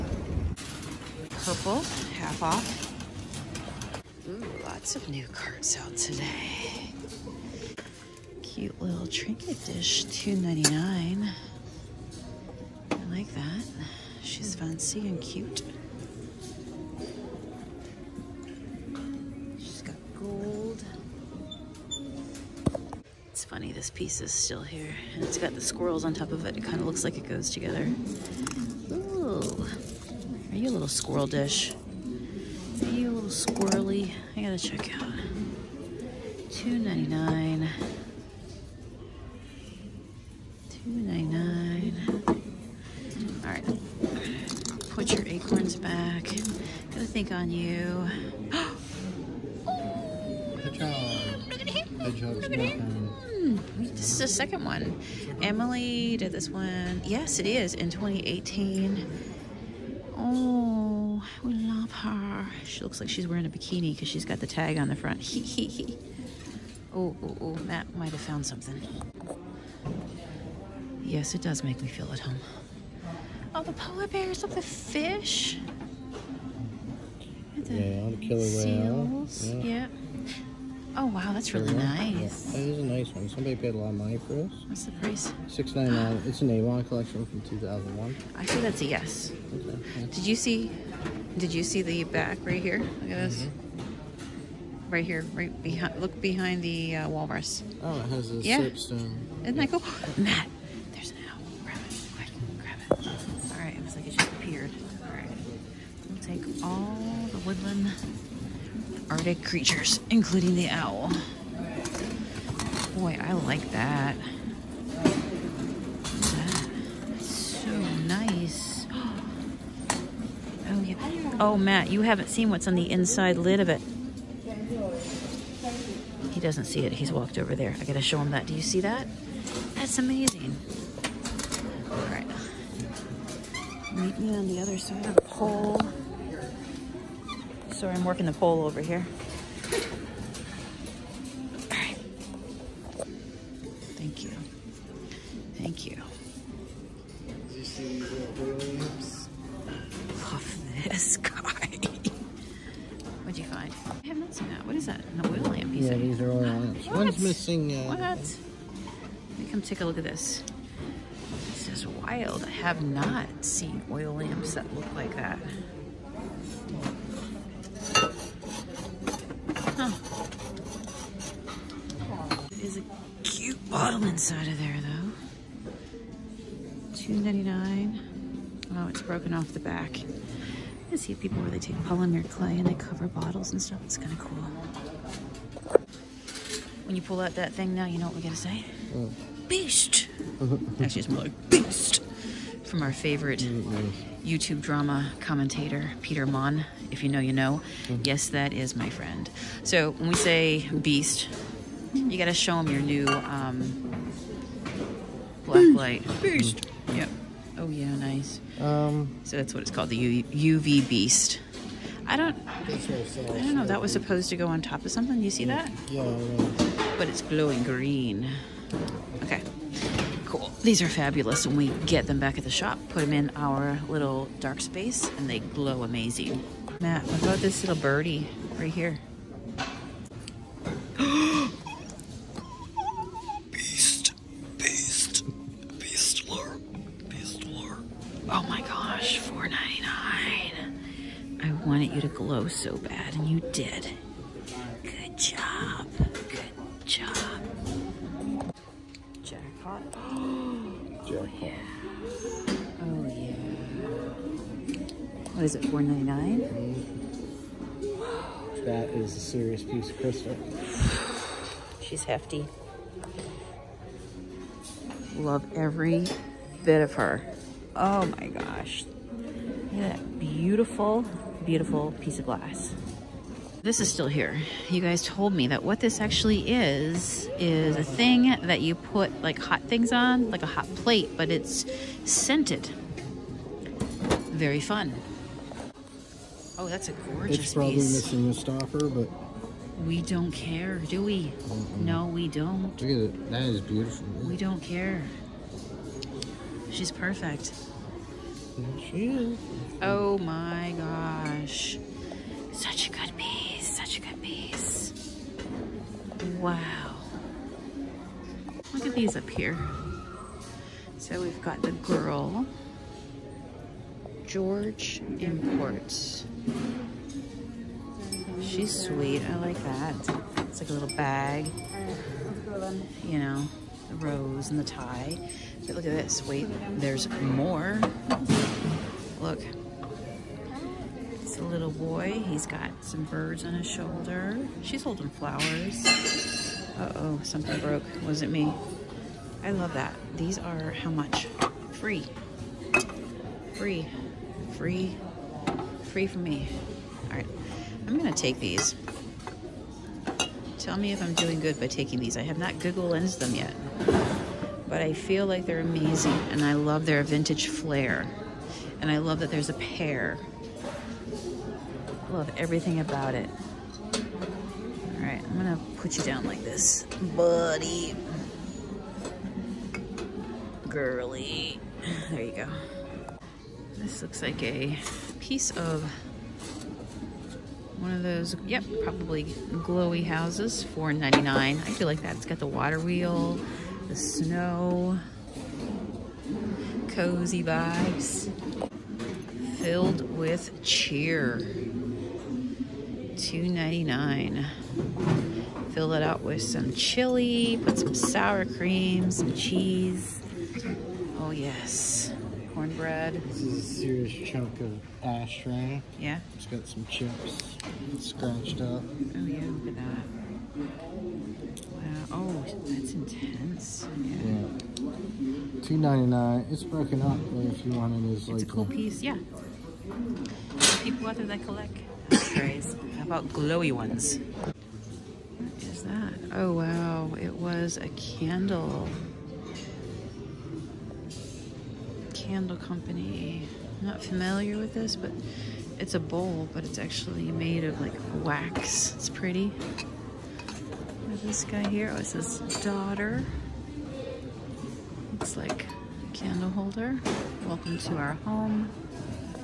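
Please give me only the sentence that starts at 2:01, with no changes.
oh, Matt, you haven't seen what's on the inside lid of it.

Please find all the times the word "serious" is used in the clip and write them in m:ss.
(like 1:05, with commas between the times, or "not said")
4:19, 6:43.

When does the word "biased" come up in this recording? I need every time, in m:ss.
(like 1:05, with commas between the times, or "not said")
not said.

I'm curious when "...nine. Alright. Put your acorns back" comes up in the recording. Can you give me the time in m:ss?
0:41.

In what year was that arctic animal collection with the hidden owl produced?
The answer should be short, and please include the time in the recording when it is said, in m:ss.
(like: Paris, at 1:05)
2001, at 1:27.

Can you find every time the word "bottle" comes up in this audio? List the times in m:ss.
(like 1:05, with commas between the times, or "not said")
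2:53, 3:03.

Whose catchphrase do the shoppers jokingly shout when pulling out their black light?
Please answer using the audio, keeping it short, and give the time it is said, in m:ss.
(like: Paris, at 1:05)
Peter Monn, at 3:16.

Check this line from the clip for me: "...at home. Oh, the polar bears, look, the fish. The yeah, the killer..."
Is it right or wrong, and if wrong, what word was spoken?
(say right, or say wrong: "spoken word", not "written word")
right.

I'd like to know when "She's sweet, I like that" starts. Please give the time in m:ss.
5:18.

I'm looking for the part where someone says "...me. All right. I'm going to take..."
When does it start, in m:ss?
5:46.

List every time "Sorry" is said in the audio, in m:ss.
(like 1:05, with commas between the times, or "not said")
2:17.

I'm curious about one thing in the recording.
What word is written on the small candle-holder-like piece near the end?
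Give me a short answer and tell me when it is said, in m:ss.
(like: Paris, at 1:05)
daughter, at 7:22.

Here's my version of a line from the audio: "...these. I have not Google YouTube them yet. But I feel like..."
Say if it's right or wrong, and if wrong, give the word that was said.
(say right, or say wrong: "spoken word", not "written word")
wrong: "Lens", not "YouTube".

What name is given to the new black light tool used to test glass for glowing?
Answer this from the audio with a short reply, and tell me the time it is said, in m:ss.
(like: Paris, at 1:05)
UV beast, at 3:29.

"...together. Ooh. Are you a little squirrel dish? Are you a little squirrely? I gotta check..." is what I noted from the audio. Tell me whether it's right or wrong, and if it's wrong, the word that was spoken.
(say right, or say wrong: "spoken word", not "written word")
right.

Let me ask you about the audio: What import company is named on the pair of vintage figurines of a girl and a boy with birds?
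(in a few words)
George Imports.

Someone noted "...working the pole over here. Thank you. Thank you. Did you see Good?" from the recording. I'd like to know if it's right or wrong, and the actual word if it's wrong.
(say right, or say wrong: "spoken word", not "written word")
wrong: "Williams", not "Good".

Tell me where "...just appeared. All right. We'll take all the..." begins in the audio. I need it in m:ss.
1:44.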